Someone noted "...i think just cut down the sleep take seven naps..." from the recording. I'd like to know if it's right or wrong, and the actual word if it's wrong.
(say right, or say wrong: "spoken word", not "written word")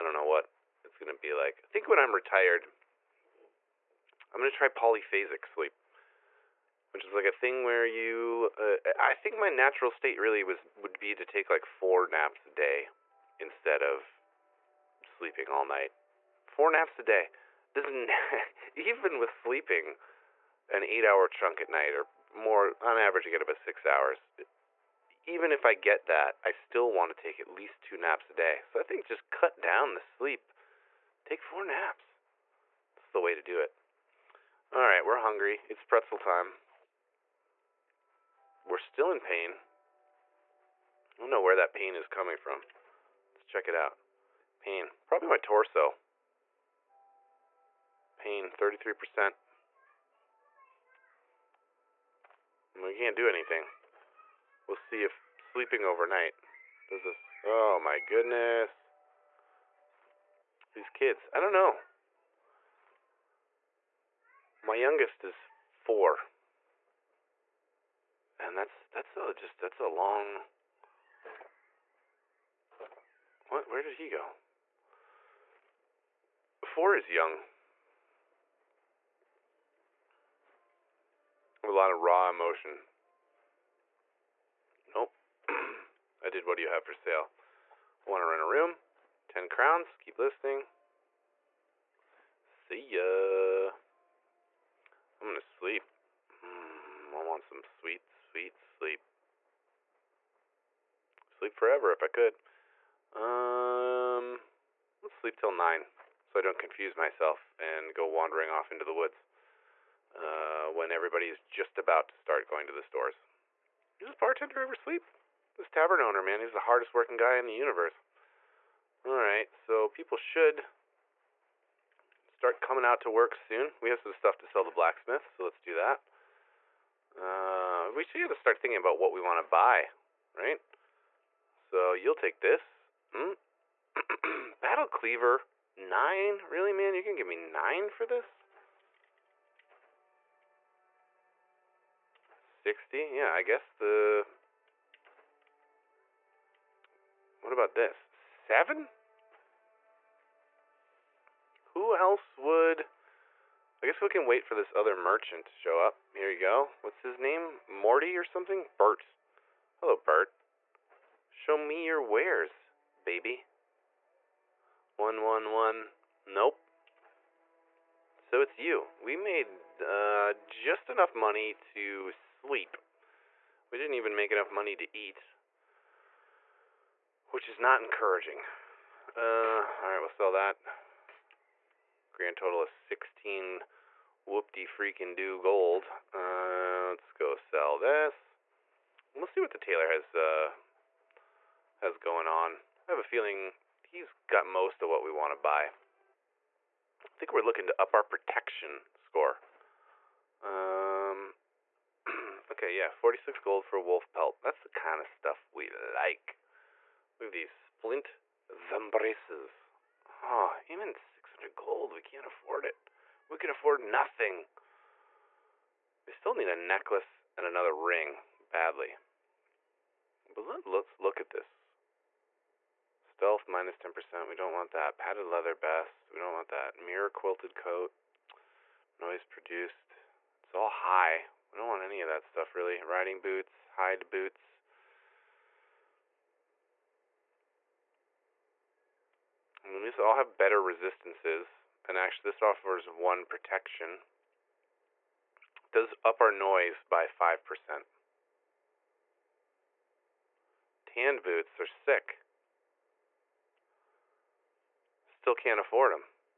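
wrong: "four", not "seven".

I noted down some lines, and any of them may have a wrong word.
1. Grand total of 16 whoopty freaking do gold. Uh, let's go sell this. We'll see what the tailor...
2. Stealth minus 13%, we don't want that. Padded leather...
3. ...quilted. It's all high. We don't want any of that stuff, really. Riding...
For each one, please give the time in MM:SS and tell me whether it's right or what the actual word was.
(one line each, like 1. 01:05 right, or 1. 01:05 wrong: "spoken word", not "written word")
1. 03:02 right
2. 03:43 wrong: "10", not "13"
3. 03:49 wrong: "produced", not "quilted".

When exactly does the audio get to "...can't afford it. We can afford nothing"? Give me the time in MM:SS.
03:32.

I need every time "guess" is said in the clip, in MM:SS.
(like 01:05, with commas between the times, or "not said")
02:23, 02:33.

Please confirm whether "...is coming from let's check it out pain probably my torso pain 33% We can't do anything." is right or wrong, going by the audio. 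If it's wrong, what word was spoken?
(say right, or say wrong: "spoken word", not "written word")
right.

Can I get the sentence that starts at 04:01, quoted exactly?
And actually, this offers one protection.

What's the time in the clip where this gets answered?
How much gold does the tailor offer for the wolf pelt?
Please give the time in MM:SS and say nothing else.
03:22.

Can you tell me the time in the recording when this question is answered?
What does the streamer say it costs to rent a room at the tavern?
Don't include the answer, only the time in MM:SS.
01:29.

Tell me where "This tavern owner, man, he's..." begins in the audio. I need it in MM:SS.
01:55.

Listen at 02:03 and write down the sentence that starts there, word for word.
We have some stuff to sell the blacksmith, so let's do that.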